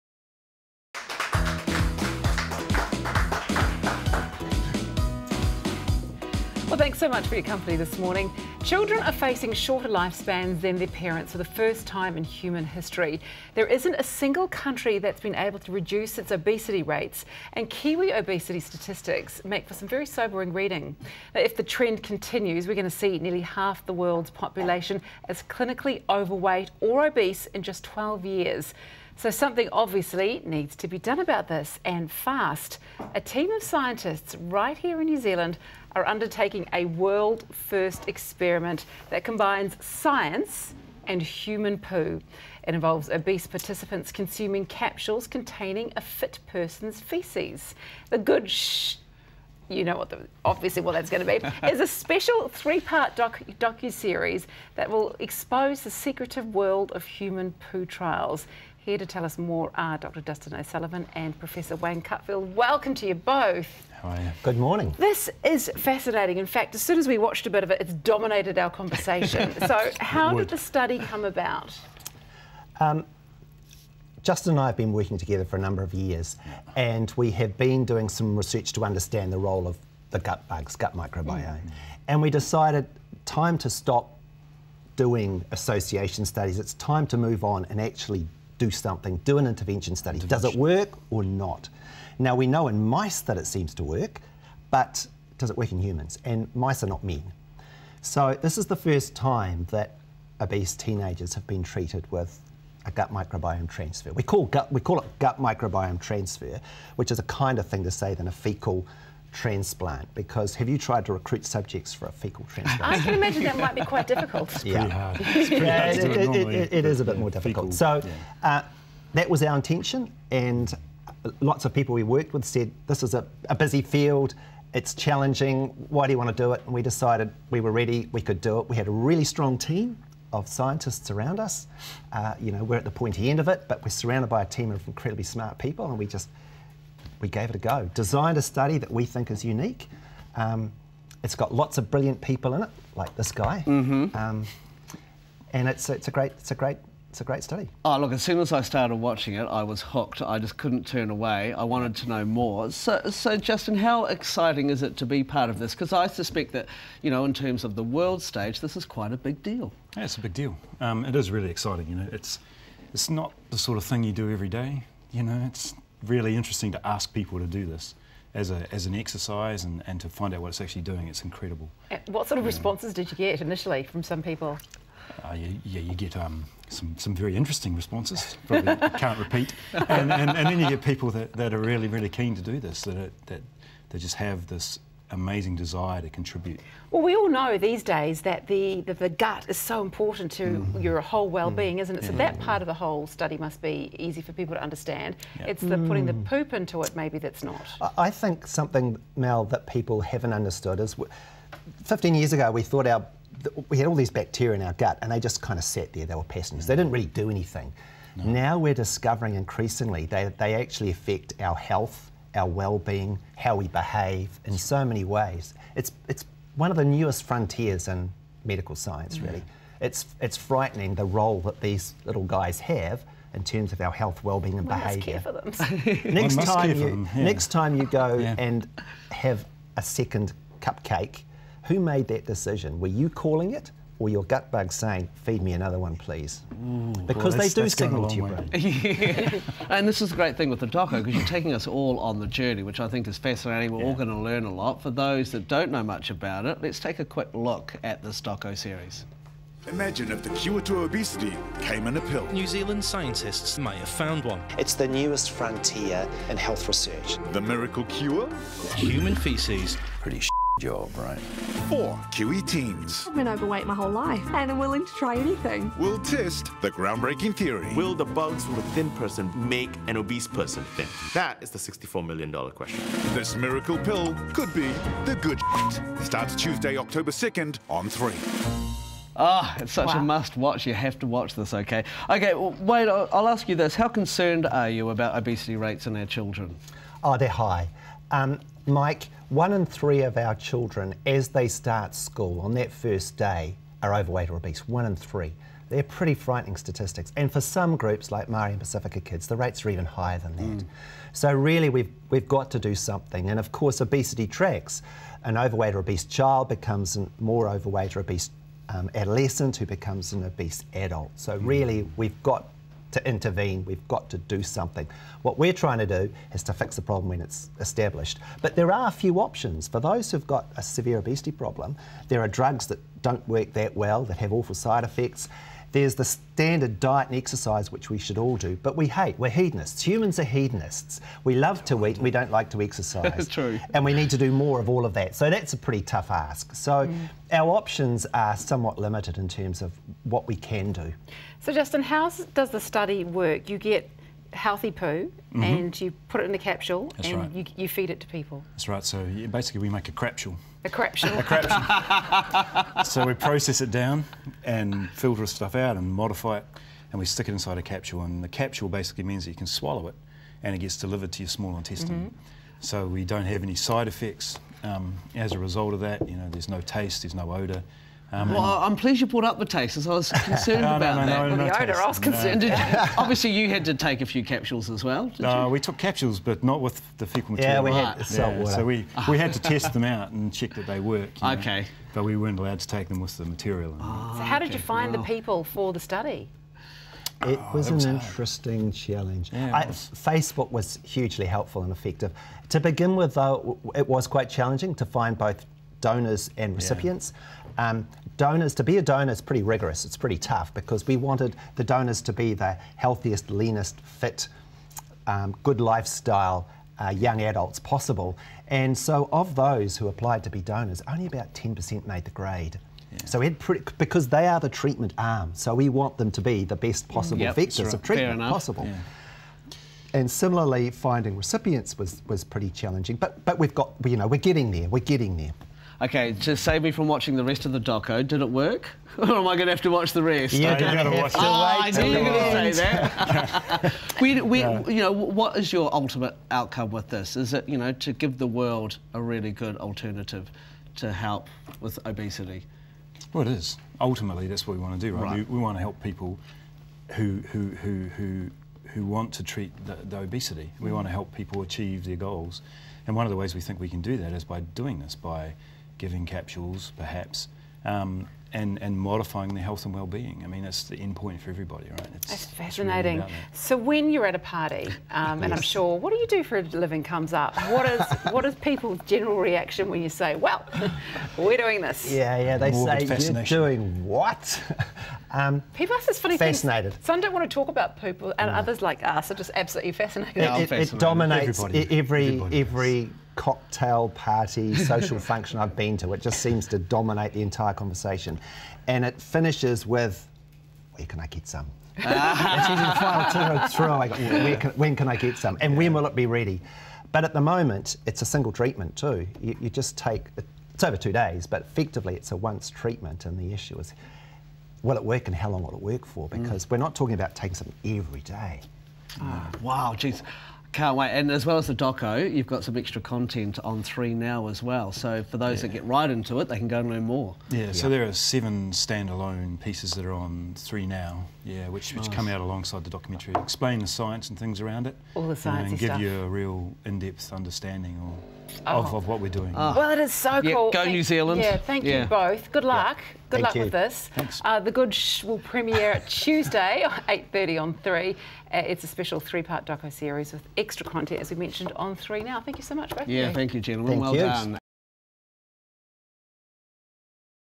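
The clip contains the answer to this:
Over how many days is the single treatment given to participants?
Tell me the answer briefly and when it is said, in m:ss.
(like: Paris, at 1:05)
2, at 8:20.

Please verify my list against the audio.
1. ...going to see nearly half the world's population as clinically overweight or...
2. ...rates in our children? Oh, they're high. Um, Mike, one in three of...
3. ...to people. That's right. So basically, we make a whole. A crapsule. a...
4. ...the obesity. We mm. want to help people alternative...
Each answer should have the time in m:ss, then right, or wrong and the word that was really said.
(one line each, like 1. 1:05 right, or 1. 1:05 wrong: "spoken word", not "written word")
1. 0:22 right
2. 4:45 right
3. 5:47 wrong: "crapsule", not "whole"
4. 7:29 wrong: "achieve", not "alternative".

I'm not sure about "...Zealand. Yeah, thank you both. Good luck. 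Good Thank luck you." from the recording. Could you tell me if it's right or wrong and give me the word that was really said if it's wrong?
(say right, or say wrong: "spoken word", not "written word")
right.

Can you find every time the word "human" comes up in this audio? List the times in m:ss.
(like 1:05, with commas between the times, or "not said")
0:12, 0:41, 0:57, 1:35, 4:18, 5:29.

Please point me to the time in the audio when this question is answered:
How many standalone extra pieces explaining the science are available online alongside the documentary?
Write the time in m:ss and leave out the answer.
8:37.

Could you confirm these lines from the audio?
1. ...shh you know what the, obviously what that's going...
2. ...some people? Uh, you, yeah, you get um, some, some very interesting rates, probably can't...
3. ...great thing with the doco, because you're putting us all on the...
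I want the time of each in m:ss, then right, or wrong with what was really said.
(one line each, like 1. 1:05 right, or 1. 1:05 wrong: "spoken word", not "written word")
1. 0:48 right
2. 2:54 wrong: "responses", not "rates"
3. 4:00 wrong: "taking", not "putting".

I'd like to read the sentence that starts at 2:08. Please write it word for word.
We had a really strong team of scientists around us.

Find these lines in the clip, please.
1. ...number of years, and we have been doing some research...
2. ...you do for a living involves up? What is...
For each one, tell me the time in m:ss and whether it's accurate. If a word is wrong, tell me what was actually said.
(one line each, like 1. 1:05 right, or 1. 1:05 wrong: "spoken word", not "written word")
1. 1:15 right
2. 7:45 wrong: "comes", not "involves".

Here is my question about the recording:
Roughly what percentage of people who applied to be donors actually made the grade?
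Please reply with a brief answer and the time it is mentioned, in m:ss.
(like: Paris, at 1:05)
10%, at 6:51.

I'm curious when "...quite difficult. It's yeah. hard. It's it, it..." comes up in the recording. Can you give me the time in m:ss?
1:53.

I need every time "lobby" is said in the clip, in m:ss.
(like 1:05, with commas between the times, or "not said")
not said.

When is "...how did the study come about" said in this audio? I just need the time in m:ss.
1:09.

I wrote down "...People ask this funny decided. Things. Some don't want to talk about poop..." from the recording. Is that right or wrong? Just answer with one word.
wrong.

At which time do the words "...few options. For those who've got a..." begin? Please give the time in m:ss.
5:18.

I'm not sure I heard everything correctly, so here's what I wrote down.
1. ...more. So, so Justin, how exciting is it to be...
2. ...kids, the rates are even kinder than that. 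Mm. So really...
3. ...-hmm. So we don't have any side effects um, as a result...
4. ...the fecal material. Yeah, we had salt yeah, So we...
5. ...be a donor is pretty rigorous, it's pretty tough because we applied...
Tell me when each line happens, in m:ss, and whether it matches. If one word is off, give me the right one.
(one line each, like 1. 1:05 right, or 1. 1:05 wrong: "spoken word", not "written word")
1. 2:32 right
2. 4:58 wrong: "higher", not "kinder"
3. 6:02 right
4. 6:16 right
5. 6:38 wrong: "wanted", not "applied".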